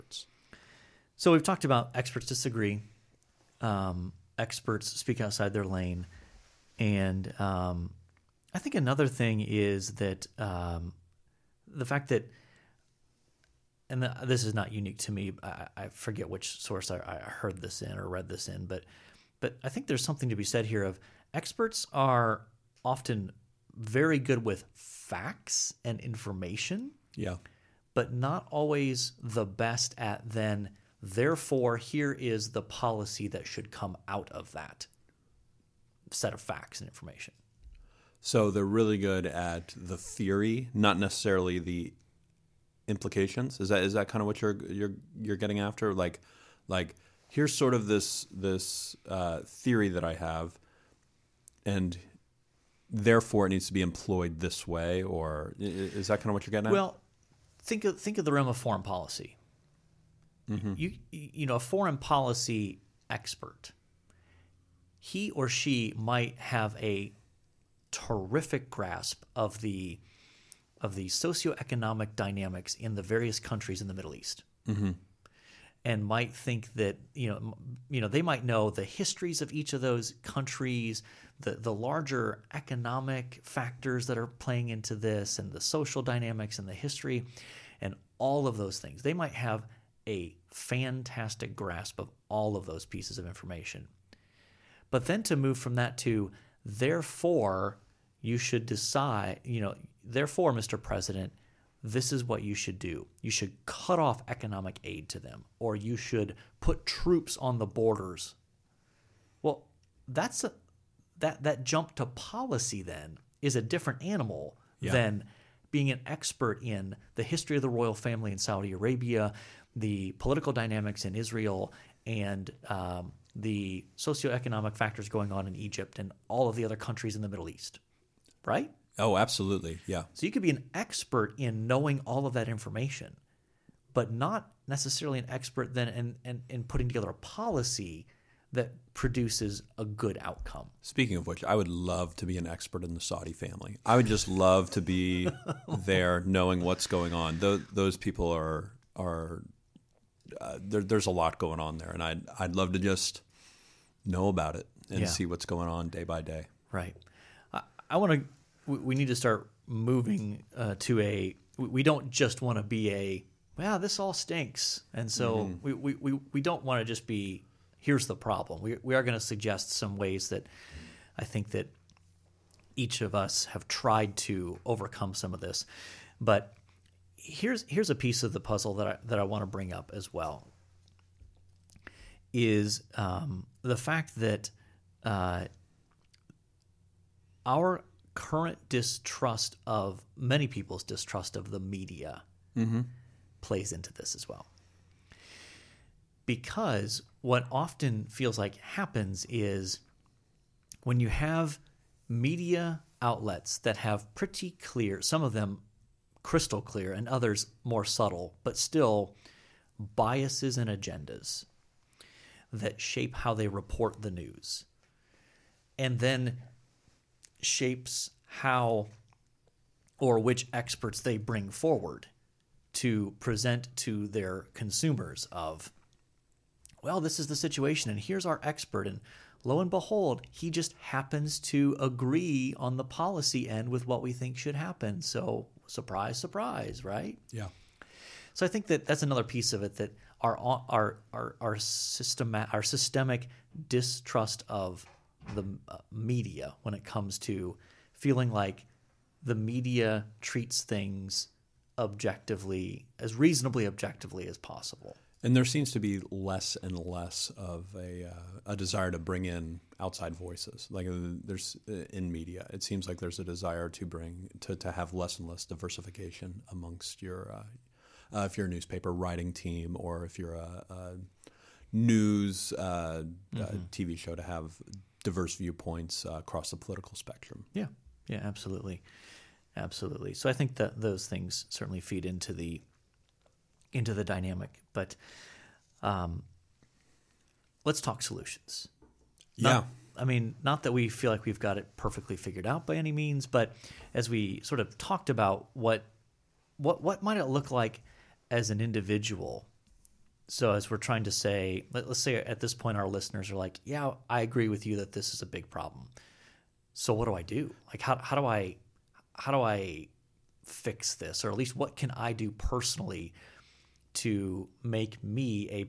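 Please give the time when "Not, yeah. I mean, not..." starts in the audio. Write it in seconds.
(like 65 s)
289 s.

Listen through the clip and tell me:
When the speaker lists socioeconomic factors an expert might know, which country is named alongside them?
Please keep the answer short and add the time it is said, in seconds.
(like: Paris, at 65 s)
Egypt, at 125 s.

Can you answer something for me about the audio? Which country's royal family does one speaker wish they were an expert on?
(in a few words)
Saudi Arabia.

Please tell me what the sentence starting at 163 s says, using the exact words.
Wow, this all stinks, and so mm-hmm.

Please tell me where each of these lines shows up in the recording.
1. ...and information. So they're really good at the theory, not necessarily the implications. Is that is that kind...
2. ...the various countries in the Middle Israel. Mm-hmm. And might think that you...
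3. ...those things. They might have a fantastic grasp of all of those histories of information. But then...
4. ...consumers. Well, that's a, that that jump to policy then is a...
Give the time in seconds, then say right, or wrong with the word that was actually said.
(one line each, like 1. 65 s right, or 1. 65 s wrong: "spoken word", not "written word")
1. 36 s right
2. 72 s wrong: "East", not "Israel"
3. 88 s wrong: "pieces", not "histories"
4. 107 s wrong: "borders", not "consumers".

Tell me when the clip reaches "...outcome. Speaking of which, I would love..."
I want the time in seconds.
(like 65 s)
140 s.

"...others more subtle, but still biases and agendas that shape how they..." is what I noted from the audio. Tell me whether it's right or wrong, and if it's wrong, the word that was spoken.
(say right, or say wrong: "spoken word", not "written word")
right.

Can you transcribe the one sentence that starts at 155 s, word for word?
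see what's going on day by day.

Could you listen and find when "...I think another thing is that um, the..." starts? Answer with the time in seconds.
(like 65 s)
8 s.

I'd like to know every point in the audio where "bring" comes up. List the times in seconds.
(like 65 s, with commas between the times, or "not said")
179 s, 221 s, 258 s, 263 s.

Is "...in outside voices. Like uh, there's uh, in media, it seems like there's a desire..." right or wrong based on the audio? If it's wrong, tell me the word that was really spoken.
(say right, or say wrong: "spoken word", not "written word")
right.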